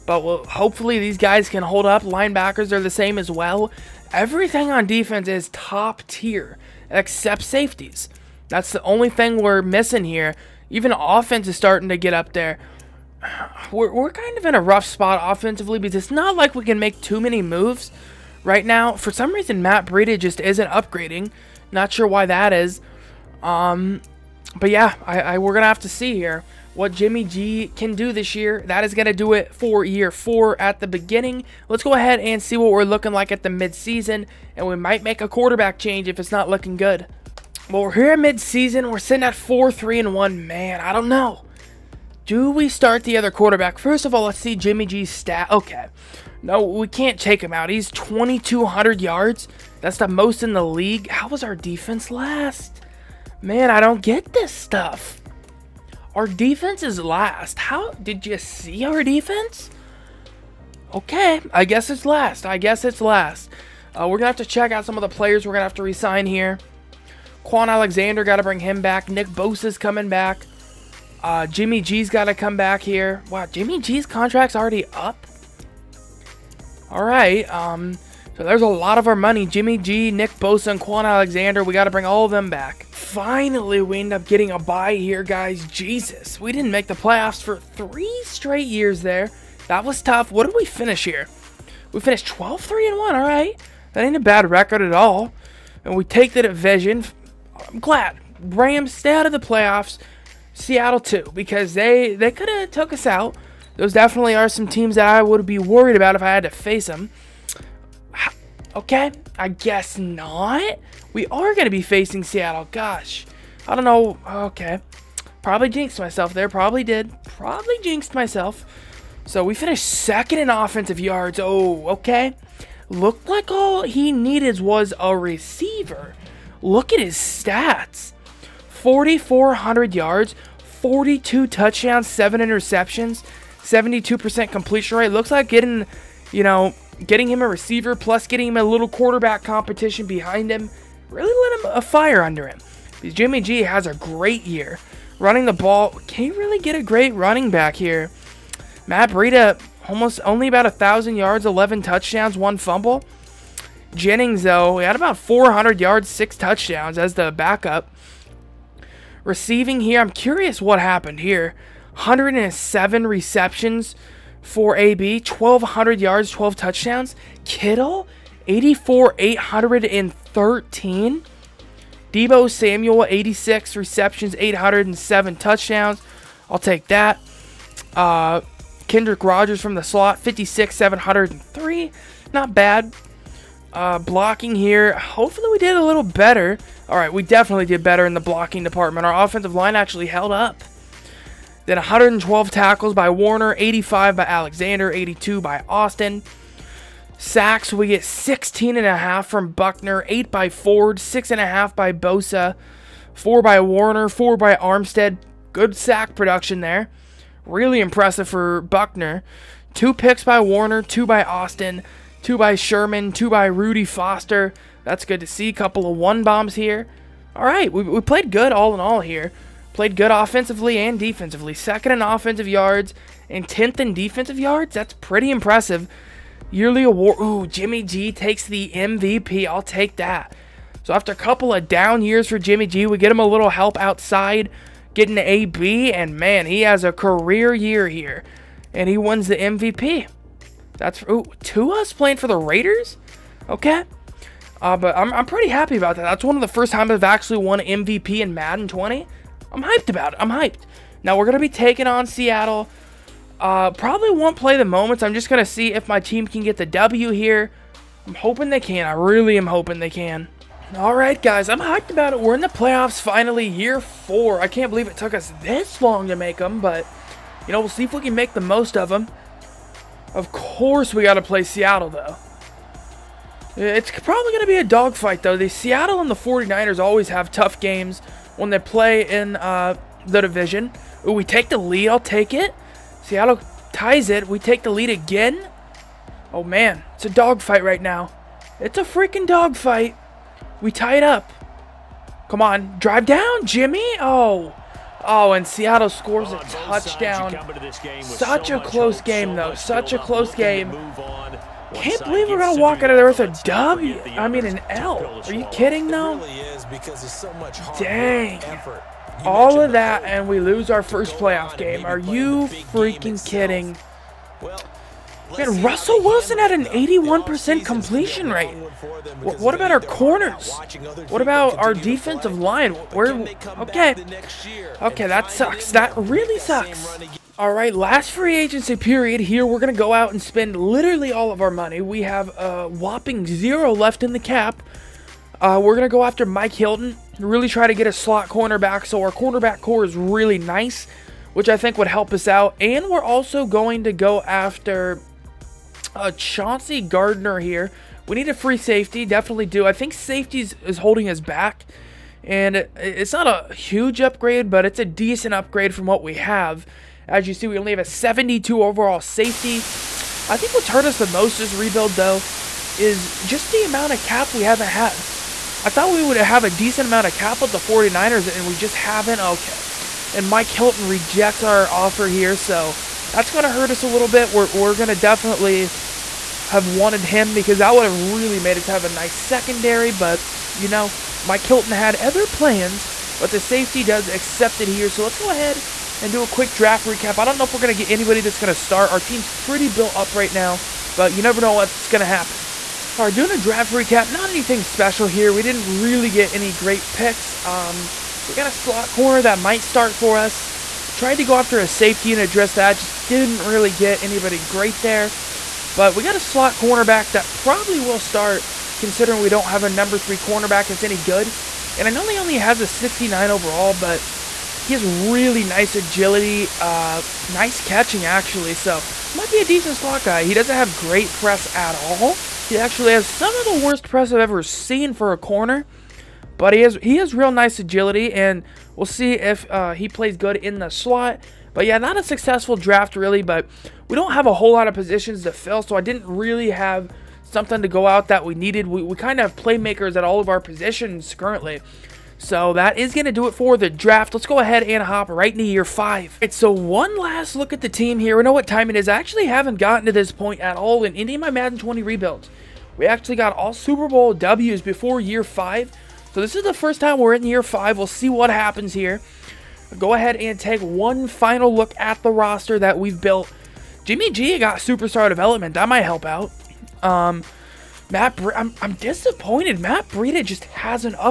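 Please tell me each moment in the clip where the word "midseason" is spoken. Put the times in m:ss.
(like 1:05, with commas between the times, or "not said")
0:33, 0:38.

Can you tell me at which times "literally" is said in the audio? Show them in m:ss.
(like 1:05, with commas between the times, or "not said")
5:30.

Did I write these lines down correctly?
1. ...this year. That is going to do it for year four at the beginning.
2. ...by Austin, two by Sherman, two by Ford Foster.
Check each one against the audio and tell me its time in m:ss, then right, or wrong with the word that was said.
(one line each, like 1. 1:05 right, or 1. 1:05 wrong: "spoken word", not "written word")
1. 0:28 right
2. 3:31 wrong: "Rudy", not "Ford".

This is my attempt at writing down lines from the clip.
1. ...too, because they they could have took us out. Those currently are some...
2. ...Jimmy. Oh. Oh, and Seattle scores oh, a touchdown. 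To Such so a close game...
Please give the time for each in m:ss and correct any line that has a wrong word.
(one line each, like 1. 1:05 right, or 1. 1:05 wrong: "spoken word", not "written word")
1. 1:40 wrong: "definitely", not "currently"
2. 4:53 right.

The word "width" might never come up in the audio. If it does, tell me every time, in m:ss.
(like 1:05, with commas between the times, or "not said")
not said.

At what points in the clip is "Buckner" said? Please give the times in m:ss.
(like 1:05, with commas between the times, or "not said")
3:19, 3:28.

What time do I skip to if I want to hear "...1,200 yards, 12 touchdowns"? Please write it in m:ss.
2:45.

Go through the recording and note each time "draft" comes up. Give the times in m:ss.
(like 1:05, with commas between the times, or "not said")
6:26, 6:33, 7:12, 7:23.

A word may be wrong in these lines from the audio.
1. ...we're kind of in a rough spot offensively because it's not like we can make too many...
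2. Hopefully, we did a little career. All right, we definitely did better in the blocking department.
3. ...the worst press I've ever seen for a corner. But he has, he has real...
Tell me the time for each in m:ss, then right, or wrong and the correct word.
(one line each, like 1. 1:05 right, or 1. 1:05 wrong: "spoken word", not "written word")
1. 0:13 right
2. 3:04 wrong: "better", not "career"
3. 7:03 right.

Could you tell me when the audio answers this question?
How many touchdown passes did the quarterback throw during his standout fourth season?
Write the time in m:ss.
2:10.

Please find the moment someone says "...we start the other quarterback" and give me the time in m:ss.
0:42.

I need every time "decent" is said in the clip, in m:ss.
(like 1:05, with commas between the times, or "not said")
5:54, 6:06, 6:59.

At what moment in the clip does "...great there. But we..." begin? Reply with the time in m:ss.
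6:44.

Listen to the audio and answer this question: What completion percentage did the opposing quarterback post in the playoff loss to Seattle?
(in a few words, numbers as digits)
81%.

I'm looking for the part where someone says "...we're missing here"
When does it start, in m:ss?
0:09.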